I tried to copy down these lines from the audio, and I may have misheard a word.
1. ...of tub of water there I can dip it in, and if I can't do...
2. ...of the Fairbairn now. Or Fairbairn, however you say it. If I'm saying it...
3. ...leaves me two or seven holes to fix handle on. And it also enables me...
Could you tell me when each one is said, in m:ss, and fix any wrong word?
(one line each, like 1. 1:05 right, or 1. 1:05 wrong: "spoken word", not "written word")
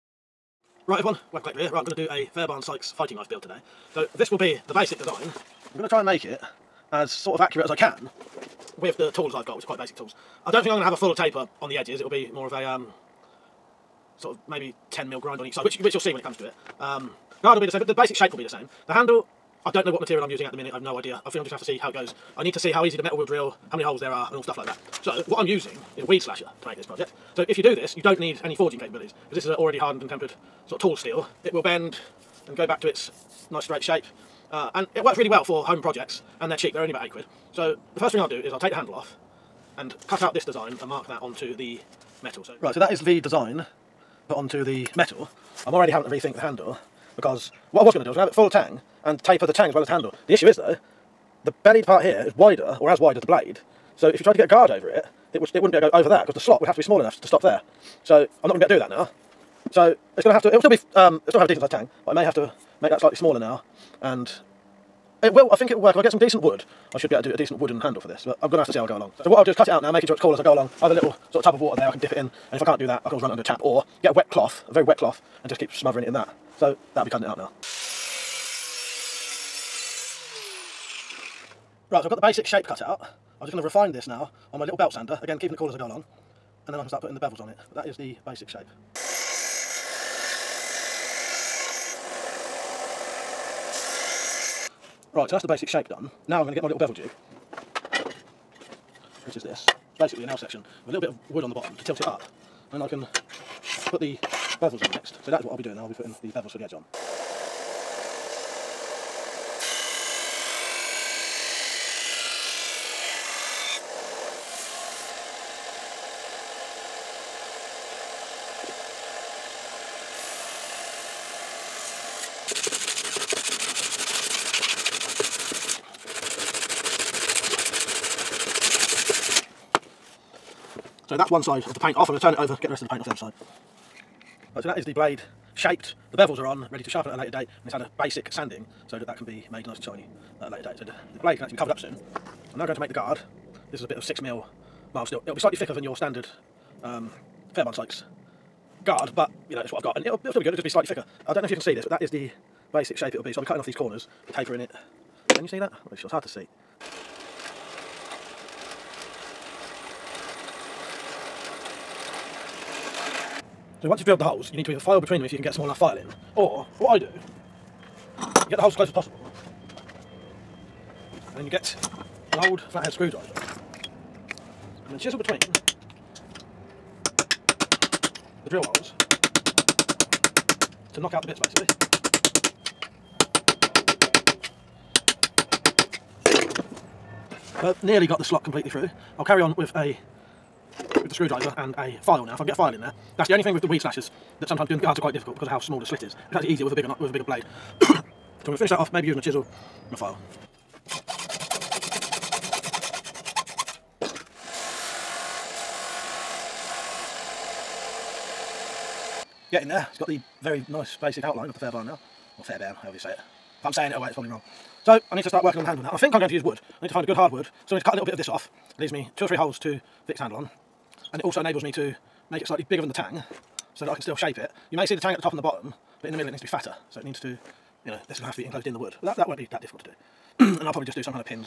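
1. 1:11 right
2. 3:31 right
3. 3:38 wrong: "three", not "seven".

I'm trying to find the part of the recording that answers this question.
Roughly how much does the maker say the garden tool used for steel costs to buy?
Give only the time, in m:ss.
0:37.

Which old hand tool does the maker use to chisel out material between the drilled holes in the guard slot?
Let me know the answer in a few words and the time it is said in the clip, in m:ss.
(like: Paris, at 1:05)
flathead screwdriver, at 2:52.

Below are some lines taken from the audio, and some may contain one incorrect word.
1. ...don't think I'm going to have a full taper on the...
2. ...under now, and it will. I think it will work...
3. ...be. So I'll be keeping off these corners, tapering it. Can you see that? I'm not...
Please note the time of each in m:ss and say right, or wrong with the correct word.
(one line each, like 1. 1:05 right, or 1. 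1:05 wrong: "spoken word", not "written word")
1. 0:10 right
2. 1:03 wrong: "smaller", not "under"
3. 2:33 wrong: "cutting", not "keeping".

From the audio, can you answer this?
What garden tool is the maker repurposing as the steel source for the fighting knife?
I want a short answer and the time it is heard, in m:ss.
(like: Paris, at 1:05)
weed slasher, at 0:26.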